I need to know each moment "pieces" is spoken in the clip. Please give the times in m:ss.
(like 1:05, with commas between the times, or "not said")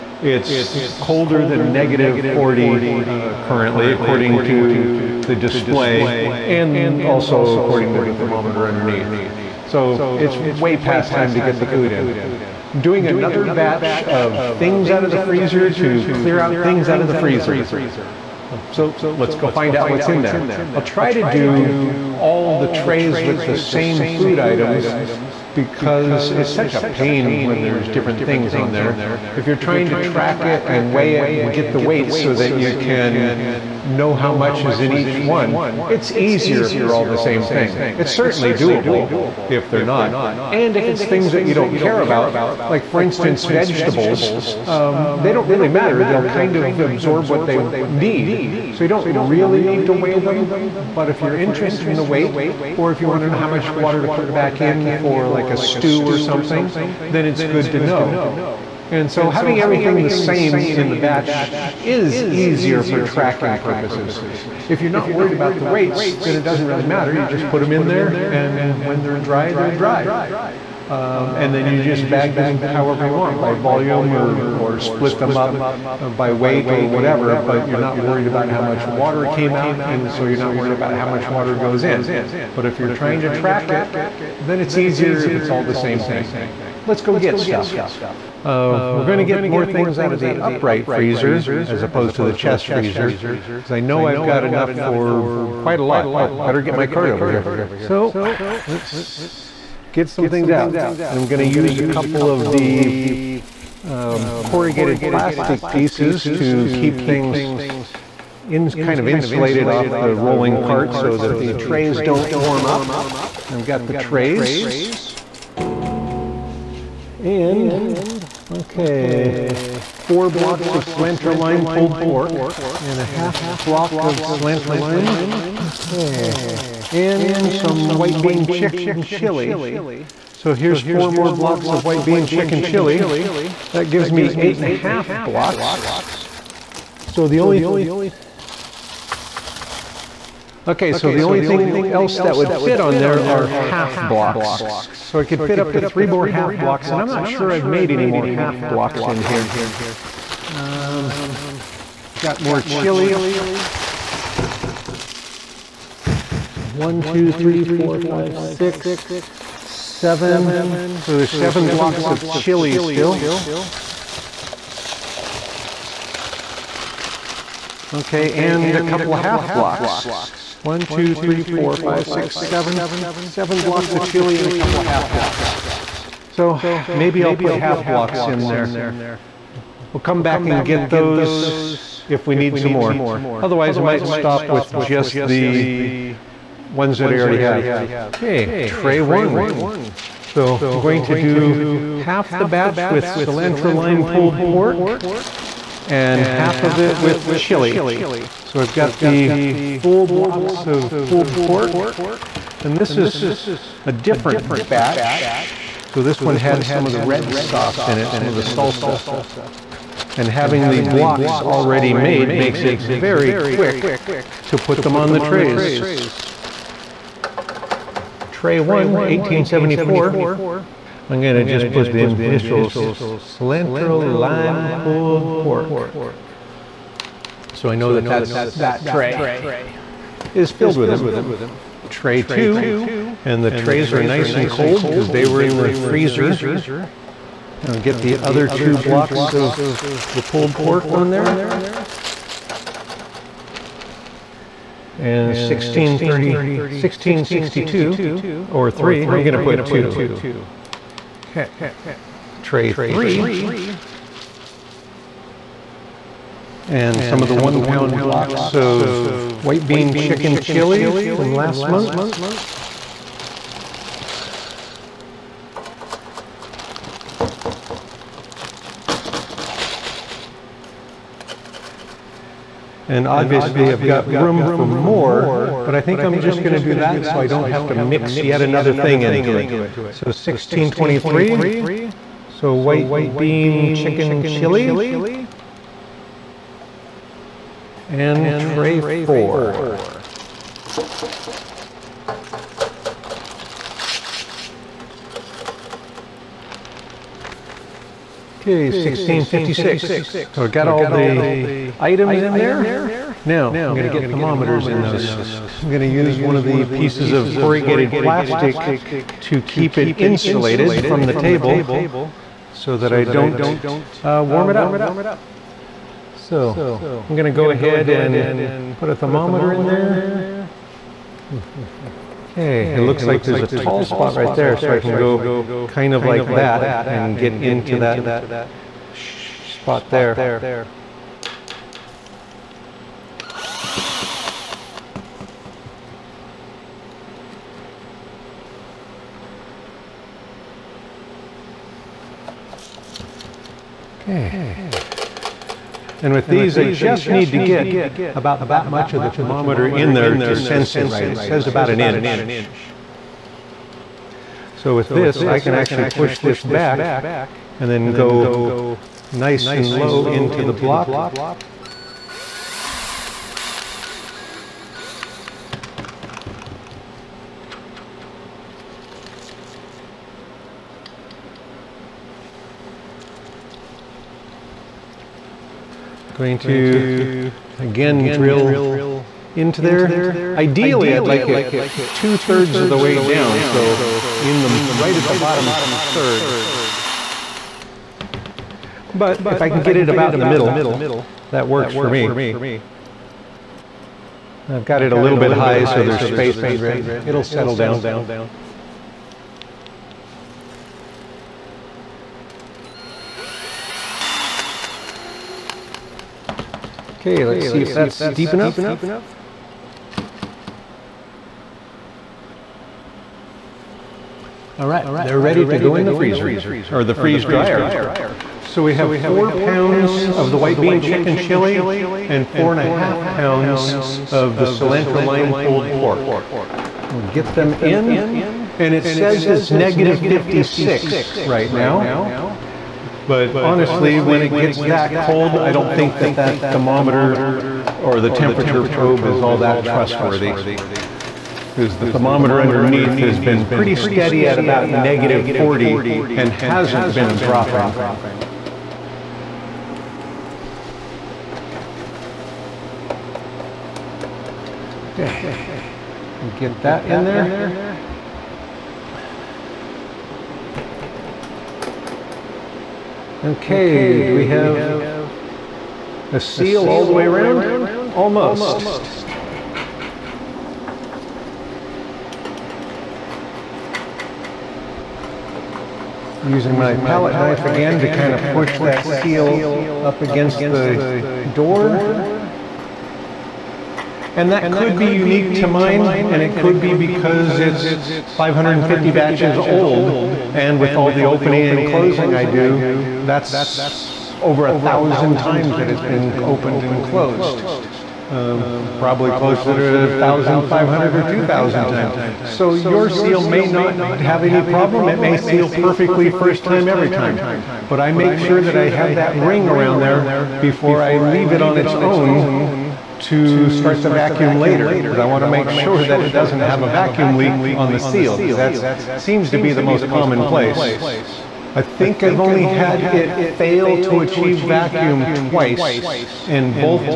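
1:45, 5:06.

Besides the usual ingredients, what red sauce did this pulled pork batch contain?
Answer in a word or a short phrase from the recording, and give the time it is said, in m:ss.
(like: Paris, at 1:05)
Salsa, at 3:28.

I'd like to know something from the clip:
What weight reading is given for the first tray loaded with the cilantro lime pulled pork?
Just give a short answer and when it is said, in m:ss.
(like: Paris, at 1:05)
1874, at 3:39.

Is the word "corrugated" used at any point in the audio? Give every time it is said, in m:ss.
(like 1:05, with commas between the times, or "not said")
1:44, 5:07.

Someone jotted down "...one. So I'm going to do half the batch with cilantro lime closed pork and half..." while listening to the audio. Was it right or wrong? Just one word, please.
wrong.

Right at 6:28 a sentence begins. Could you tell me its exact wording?
But if I can get it about in the middle, that works for me.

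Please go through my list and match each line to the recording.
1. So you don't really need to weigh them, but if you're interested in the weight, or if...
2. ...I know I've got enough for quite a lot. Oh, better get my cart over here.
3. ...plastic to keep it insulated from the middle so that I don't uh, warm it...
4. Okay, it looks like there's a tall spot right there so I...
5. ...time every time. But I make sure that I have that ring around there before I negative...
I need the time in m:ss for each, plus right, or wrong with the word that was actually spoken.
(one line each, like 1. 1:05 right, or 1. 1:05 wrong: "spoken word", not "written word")
1. 0:48 right
2. 1:33 right
3. 5:07 wrong: "table", not "middle"
4. 5:22 right
5. 8:26 wrong: "leave", not "negative".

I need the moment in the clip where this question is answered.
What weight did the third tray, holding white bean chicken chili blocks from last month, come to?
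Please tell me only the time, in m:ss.
4:40.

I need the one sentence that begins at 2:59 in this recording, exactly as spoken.
We'll come back and get those if we need some more.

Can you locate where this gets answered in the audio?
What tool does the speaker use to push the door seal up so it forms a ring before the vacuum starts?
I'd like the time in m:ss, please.
7:56.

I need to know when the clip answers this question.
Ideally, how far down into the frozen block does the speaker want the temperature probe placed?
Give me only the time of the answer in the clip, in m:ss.
6:21.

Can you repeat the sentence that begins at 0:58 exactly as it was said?
And so having everything the same in the batch is easier for tracking purposes.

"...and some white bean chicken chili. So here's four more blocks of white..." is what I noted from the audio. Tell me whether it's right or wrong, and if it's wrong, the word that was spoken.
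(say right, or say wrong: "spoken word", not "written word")
right.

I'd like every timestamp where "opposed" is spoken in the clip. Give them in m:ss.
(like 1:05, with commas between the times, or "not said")
1:31.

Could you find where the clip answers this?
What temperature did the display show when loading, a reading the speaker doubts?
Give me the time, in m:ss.
7:09.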